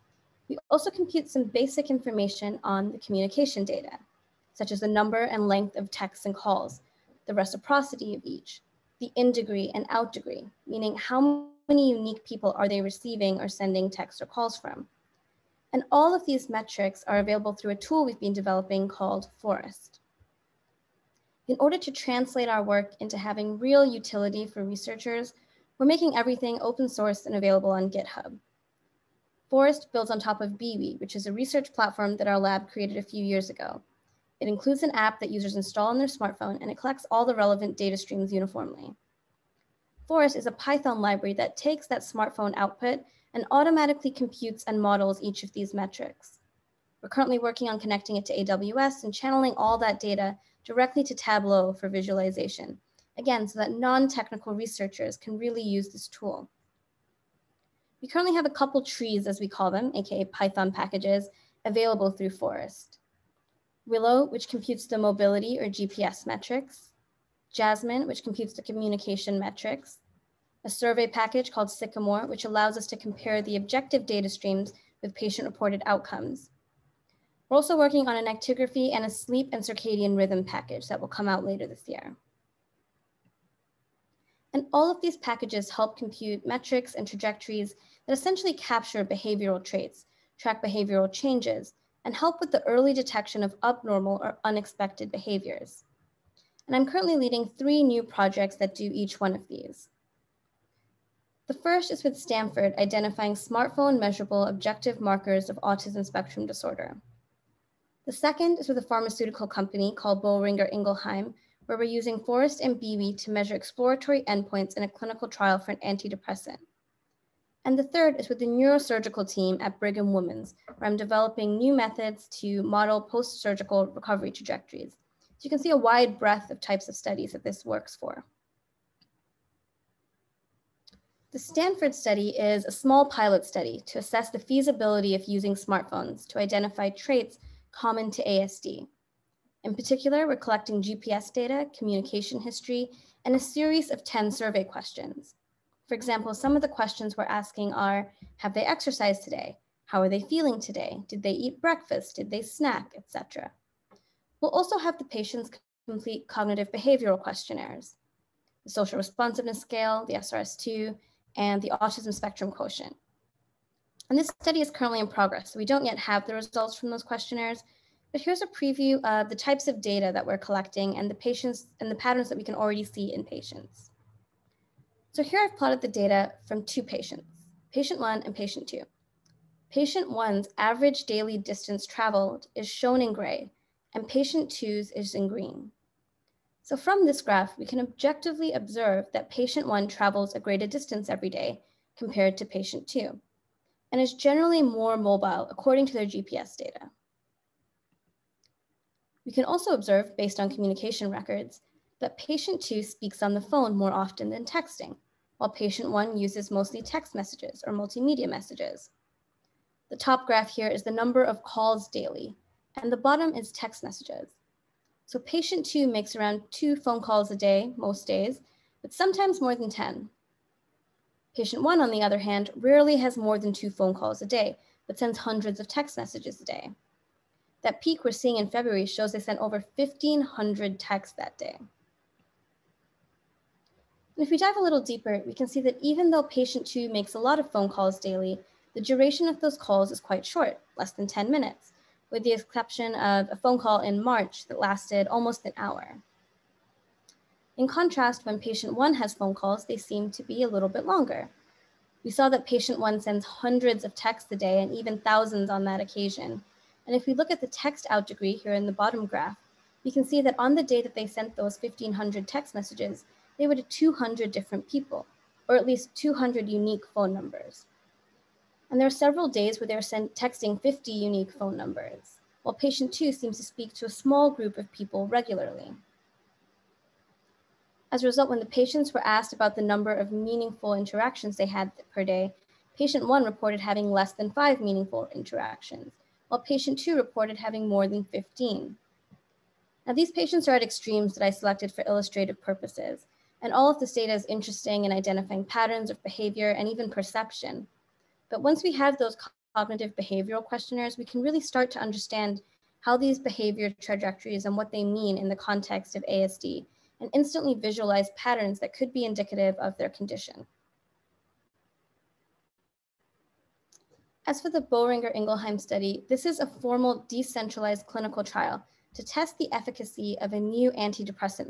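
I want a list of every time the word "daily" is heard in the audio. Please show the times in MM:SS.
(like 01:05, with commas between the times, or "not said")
03:01, 03:31, 03:58.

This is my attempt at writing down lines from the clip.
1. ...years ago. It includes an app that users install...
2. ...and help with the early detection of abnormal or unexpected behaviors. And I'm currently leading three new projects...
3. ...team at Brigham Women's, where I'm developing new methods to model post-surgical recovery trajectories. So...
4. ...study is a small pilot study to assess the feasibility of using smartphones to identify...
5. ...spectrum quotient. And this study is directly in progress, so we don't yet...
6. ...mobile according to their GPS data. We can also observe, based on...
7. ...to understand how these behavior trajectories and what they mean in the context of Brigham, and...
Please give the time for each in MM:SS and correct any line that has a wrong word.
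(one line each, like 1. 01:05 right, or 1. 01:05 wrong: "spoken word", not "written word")
1. 00:33 right
2. 01:32 right
3. 01:59 right
4. 02:11 right
5. 02:42 wrong: "currently", not "directly"
6. 03:14 right
7. 05:01 wrong: "ASD", not "Brigham".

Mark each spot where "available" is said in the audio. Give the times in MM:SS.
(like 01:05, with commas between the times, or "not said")
00:17, 00:27, 01:01.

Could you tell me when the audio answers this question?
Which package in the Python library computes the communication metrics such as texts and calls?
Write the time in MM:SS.
01:07.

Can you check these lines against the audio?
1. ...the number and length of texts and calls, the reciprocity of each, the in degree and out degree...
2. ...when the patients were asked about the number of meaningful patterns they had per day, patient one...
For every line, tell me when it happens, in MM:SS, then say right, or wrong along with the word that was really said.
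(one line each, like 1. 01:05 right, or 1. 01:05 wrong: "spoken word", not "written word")
1. 00:04 right
2. 04:38 wrong: "interactions", not "patterns".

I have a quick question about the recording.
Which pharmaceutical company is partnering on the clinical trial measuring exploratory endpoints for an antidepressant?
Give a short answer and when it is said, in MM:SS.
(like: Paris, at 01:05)
Boehringer Ingelheim, at 01:50.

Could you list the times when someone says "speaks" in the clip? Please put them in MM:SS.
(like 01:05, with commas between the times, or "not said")
03:22, 04:33.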